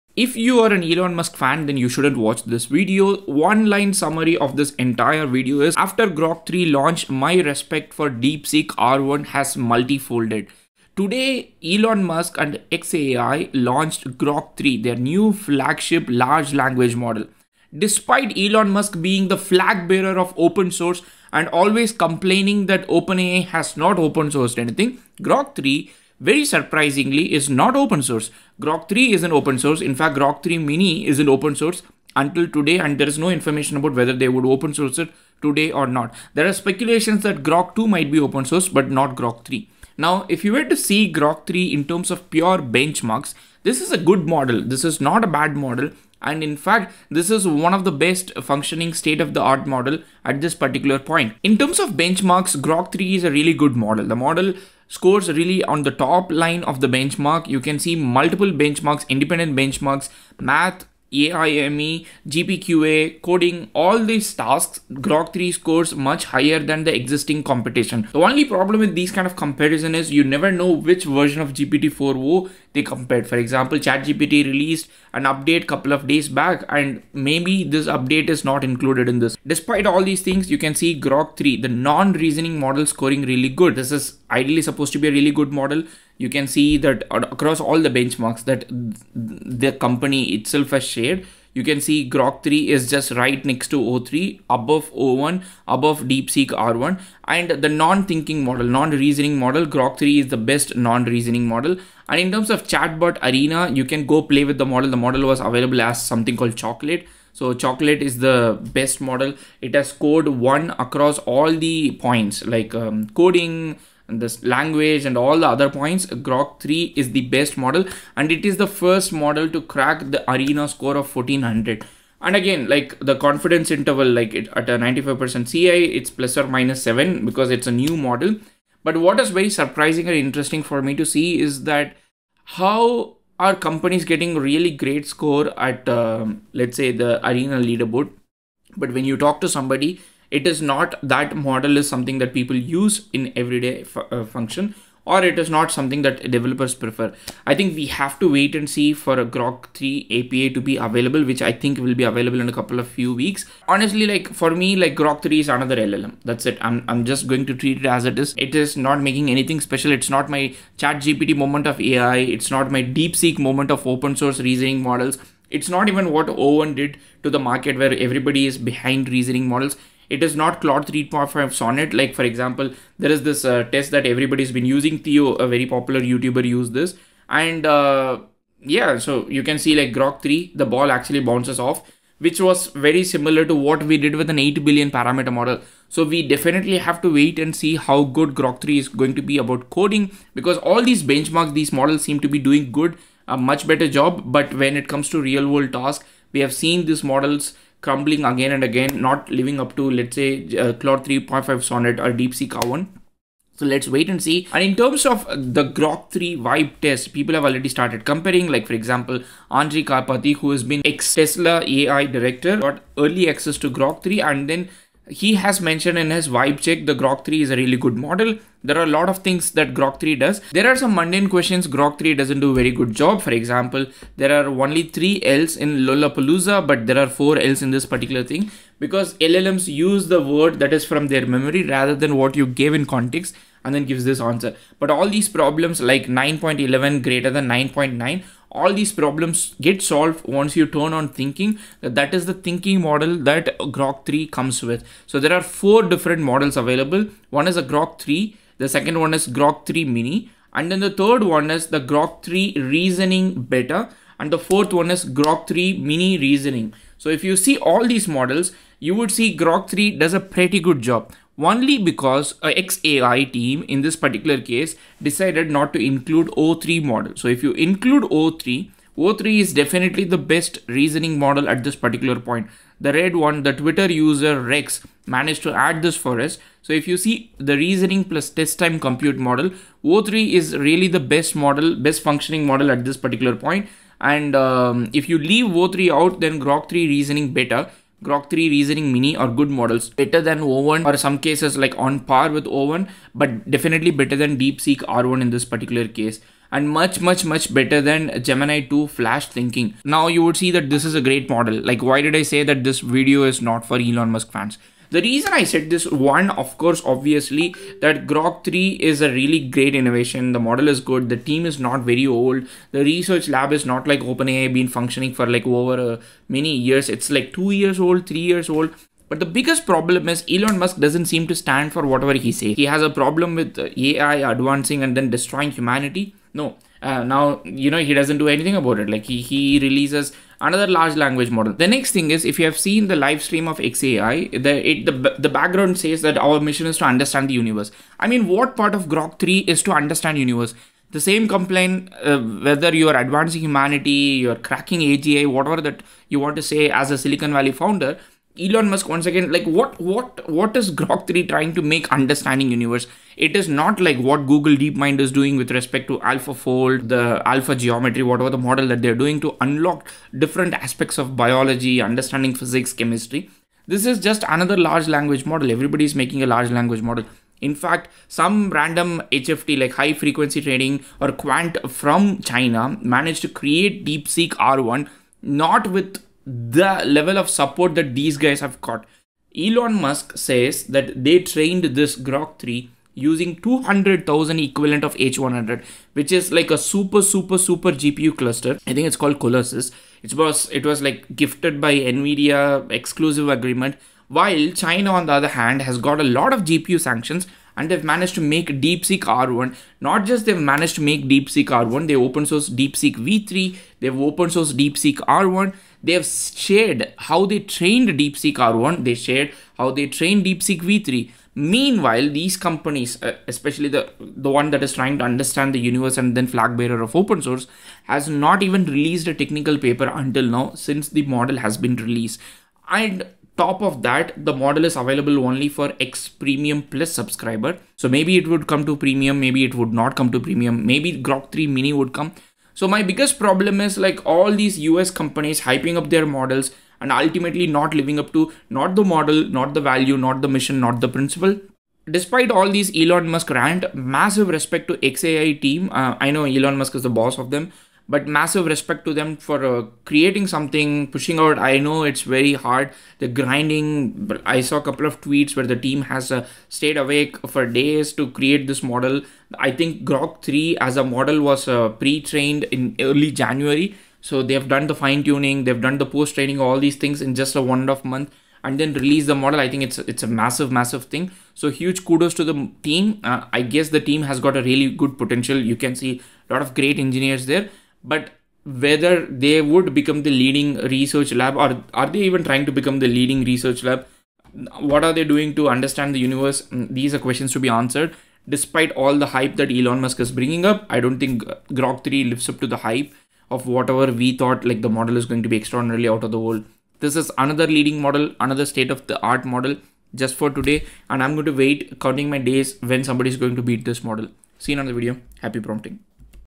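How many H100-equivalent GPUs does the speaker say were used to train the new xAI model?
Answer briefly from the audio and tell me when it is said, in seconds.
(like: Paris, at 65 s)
200,000, at 383 s.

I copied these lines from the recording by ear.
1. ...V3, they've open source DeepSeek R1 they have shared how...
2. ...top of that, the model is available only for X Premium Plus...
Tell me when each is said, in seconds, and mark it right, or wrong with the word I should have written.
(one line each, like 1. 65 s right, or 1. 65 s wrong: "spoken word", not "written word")
1. 402 s right
2. 423 s right.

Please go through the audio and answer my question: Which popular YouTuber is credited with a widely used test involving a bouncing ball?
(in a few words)
Theo.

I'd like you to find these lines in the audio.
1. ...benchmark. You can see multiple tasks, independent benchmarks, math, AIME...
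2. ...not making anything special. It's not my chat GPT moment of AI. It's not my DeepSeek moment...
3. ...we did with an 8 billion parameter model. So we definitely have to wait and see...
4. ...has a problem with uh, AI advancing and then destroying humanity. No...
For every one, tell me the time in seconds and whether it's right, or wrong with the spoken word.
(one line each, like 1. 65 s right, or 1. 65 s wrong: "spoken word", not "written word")
1. 56 s wrong: "benchmarks", not "tasks"
2. 158 s right
3. 183 s right
4. 322 s right.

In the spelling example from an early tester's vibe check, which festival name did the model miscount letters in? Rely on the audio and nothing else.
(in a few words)
Lollapalooza.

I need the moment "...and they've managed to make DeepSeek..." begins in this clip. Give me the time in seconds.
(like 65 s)
397 s.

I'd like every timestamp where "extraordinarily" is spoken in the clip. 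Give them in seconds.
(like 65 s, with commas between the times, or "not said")
495 s.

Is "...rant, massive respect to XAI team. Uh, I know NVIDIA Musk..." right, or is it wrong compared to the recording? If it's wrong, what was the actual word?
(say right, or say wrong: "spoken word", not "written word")
wrong: "Elon", not "NVIDIA".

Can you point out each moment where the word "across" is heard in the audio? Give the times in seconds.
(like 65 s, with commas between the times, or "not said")
87 s, 110 s.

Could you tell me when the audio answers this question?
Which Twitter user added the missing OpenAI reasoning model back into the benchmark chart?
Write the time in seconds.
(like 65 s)
274 s.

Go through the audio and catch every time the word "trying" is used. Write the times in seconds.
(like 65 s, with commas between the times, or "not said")
351 s, 414 s, 482 s.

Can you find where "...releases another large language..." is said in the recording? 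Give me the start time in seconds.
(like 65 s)
329 s.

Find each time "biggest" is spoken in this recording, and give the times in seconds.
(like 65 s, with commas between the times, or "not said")
319 s, 432 s.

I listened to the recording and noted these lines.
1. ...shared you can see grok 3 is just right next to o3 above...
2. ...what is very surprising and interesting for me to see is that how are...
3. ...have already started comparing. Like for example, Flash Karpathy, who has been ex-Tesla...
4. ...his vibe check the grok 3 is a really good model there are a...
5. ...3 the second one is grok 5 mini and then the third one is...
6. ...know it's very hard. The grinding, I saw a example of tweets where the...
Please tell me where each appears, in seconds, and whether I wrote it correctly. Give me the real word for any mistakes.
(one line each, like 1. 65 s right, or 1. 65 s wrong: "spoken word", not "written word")
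1. 90 s right
2. 128 s right
3. 207 s wrong: "Andrej", not "Flash"
4. 216 s right
5. 248 s wrong: "3", not "5"
6. 451 s wrong: "couple", not "example".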